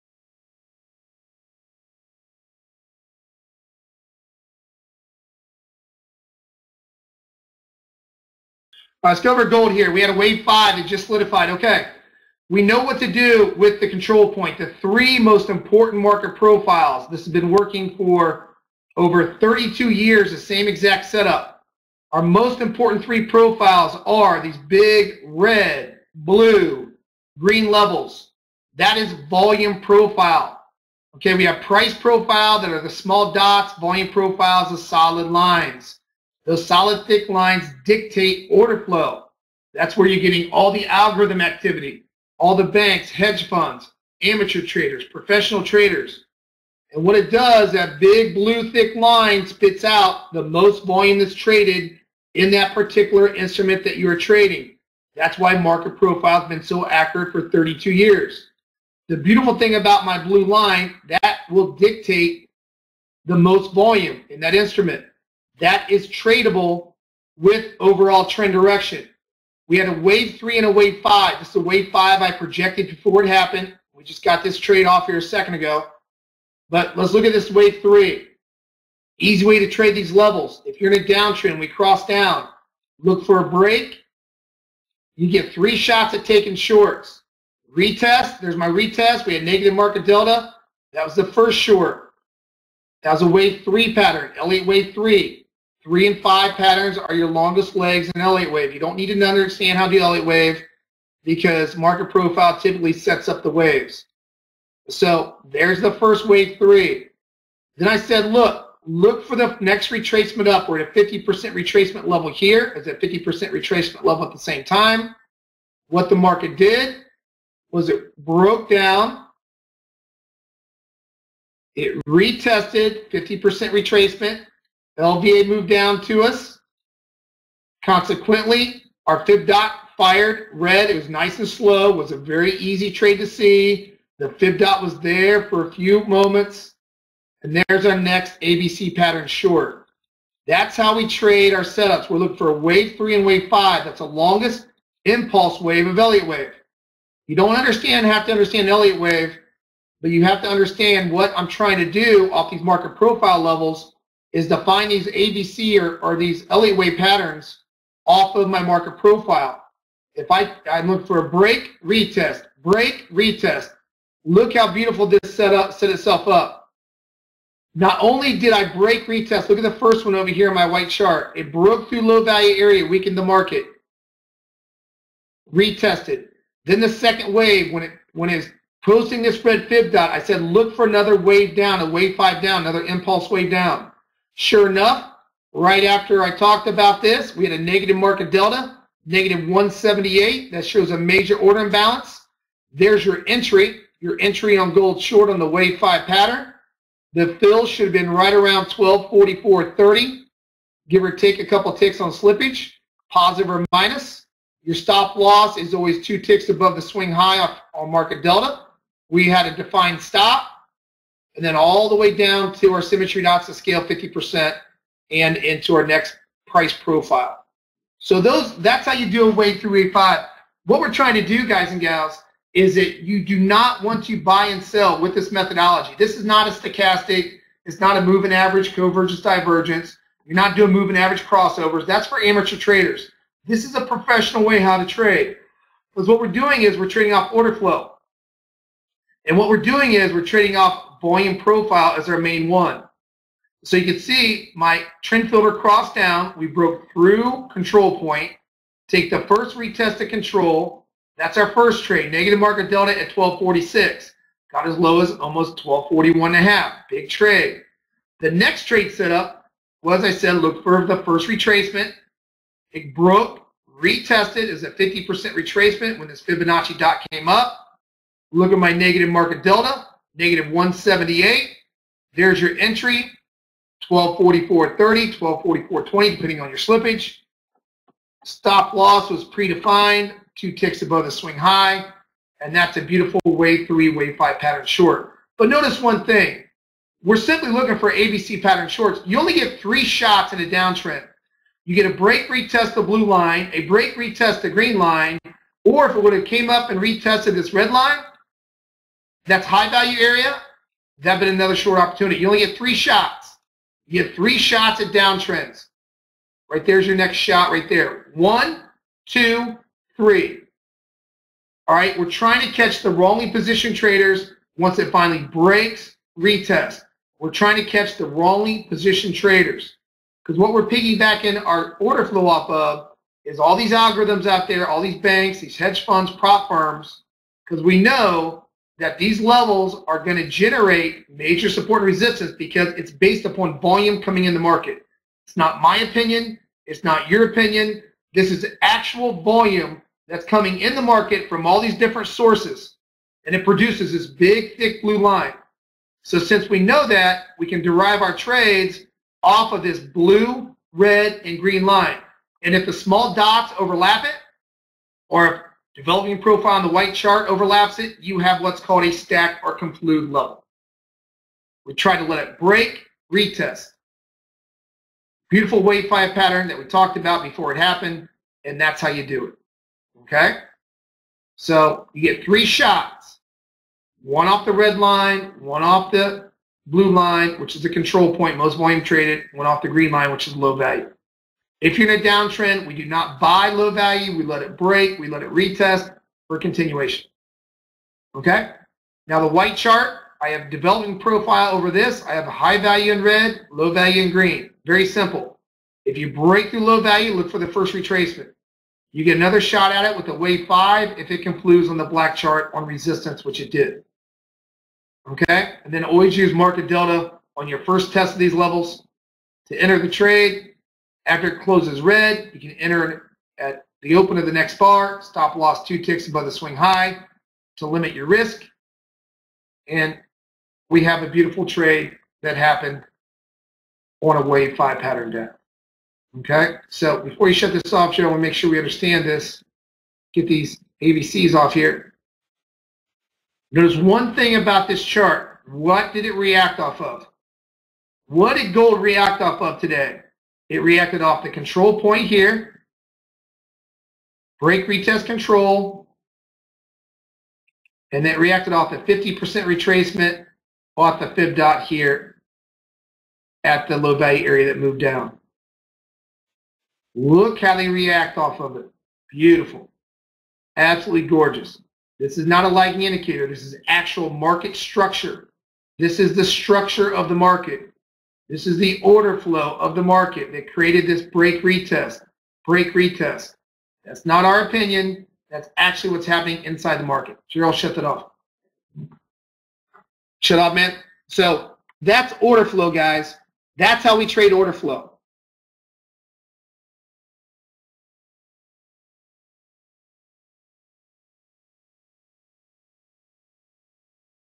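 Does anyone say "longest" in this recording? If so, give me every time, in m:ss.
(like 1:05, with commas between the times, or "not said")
1:37, 2:24.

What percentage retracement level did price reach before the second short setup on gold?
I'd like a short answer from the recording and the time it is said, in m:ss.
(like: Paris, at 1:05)
50%, at 1:50.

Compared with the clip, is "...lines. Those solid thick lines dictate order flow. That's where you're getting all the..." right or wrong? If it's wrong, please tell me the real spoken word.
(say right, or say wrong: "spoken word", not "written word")
right.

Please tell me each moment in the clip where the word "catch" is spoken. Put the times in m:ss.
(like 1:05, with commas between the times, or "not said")
5:12, 5:17.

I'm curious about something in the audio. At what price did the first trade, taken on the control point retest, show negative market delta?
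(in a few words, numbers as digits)
1246.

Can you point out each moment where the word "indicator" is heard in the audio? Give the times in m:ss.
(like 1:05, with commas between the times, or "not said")
7:42.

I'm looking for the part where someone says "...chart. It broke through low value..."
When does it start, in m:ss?
2:50.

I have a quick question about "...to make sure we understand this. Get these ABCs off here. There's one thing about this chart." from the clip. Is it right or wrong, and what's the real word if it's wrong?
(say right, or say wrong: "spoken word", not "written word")
right.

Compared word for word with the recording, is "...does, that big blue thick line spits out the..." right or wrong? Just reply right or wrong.
right.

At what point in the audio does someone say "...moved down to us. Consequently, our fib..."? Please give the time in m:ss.
2:05.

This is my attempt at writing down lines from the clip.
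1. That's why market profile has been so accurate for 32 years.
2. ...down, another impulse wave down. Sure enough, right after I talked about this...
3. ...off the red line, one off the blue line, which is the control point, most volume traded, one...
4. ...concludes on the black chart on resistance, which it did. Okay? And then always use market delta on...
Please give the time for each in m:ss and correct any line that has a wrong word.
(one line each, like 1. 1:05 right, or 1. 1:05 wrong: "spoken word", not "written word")
1. 0:55 right
2. 3:02 right
3. 6:14 right
4. 6:41 right.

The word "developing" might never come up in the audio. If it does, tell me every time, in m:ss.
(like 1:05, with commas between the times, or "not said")
5:55, 6:30.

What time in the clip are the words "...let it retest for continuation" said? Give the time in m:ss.
6:25.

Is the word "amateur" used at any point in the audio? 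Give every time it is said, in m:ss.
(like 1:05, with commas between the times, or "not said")
0:44, 3:52.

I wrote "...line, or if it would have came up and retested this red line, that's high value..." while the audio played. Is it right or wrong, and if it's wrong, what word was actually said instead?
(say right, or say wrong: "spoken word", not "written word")
right.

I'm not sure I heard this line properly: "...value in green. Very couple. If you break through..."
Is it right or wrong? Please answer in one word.
wrong.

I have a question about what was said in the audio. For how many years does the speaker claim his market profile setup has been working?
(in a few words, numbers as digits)
32 years.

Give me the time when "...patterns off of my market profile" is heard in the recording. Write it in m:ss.
2:36.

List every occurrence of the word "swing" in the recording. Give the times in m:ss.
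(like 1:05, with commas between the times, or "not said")
3:26, 4:41, 6:56.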